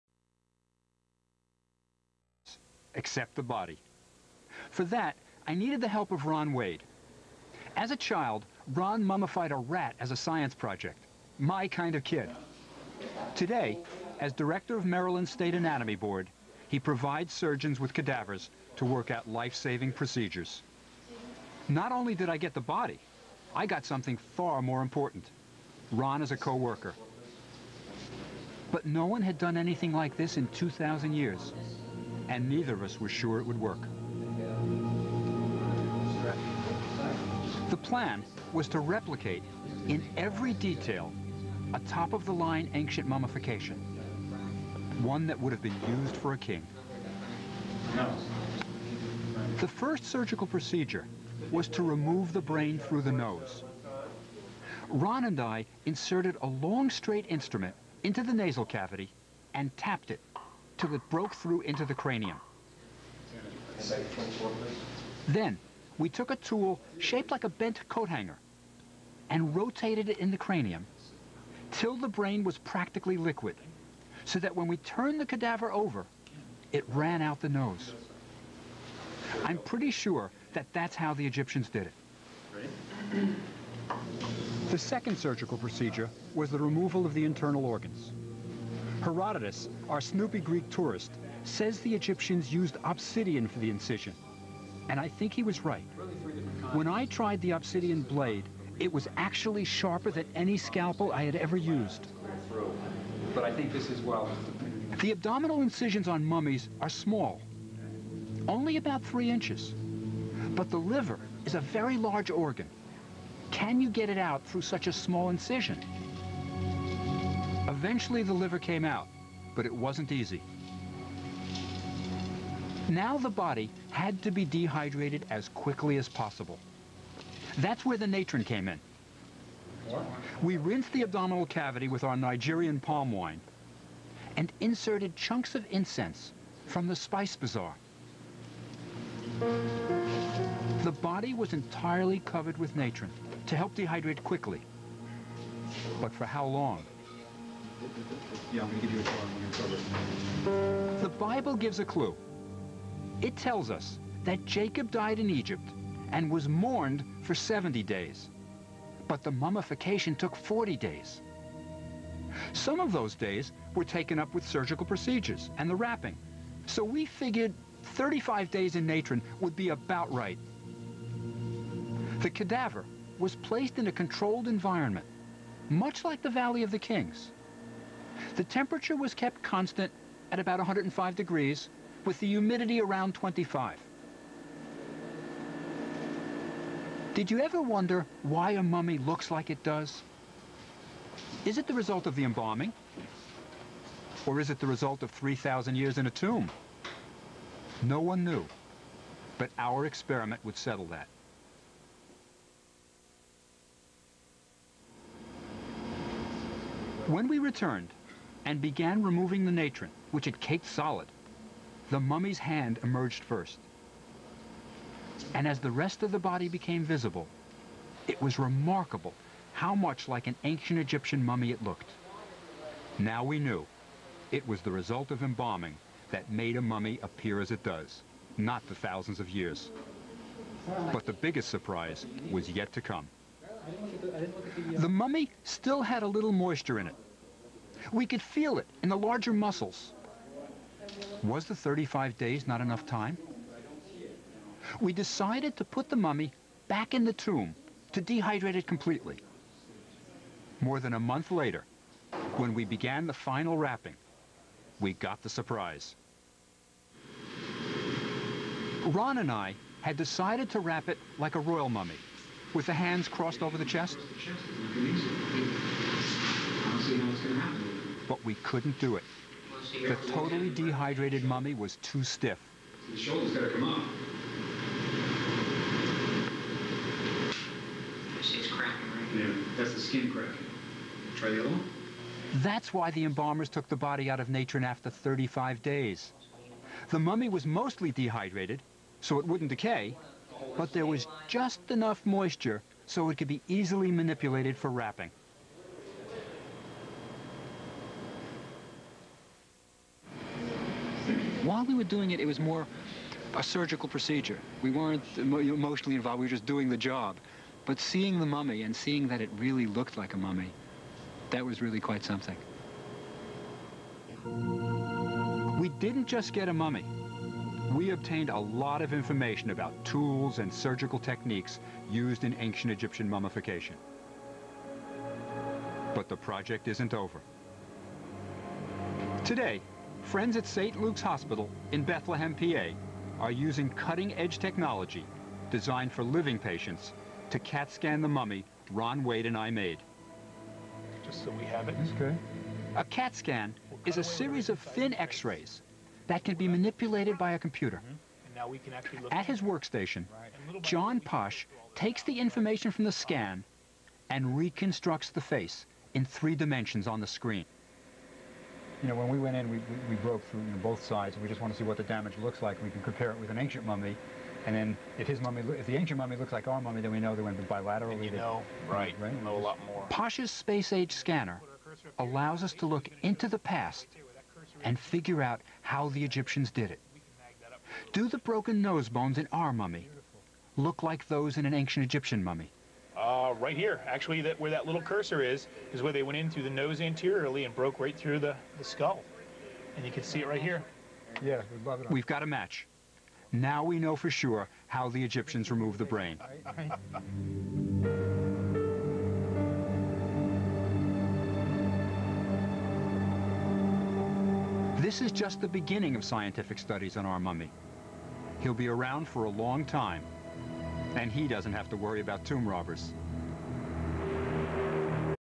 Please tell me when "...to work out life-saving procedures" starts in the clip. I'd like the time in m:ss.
0:18.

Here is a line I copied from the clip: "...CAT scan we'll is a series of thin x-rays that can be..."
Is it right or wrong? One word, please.
right.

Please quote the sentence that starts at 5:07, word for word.
But seeing the mummy and seeing that it really looked like a mummy, that was really quite something.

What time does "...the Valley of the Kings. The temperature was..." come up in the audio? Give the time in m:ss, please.
2:56.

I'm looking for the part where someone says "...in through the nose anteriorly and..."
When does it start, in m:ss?
6:26.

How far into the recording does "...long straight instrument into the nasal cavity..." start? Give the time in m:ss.
0:56.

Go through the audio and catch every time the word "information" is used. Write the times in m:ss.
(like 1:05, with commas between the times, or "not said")
5:18, 5:52.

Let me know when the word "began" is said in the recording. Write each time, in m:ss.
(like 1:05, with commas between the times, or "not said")
3:28, 4:12.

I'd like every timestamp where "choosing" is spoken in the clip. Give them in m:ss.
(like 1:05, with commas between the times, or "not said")
not said.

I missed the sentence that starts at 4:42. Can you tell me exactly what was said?
That's why the embalmers took the body out of Natron after 35 days.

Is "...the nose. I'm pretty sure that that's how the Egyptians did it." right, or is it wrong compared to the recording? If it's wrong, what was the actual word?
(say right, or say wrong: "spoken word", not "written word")
right.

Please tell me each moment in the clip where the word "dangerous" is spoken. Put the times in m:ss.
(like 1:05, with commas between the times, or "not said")
not said.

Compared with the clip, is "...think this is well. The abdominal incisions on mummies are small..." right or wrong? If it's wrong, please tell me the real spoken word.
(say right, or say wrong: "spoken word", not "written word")
right.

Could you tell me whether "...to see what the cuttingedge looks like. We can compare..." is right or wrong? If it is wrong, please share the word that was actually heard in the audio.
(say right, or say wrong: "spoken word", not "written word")
wrong: "damage", not "cuttingedge".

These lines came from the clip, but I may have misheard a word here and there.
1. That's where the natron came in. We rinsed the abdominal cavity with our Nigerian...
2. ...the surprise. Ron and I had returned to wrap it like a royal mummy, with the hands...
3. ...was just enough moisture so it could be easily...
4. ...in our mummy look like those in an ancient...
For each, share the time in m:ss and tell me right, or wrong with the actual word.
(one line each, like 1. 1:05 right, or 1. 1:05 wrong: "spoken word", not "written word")
1. 2:07 right
2. 4:15 wrong: "decided", not "returned"
3. 4:50 right
4. 6:19 right.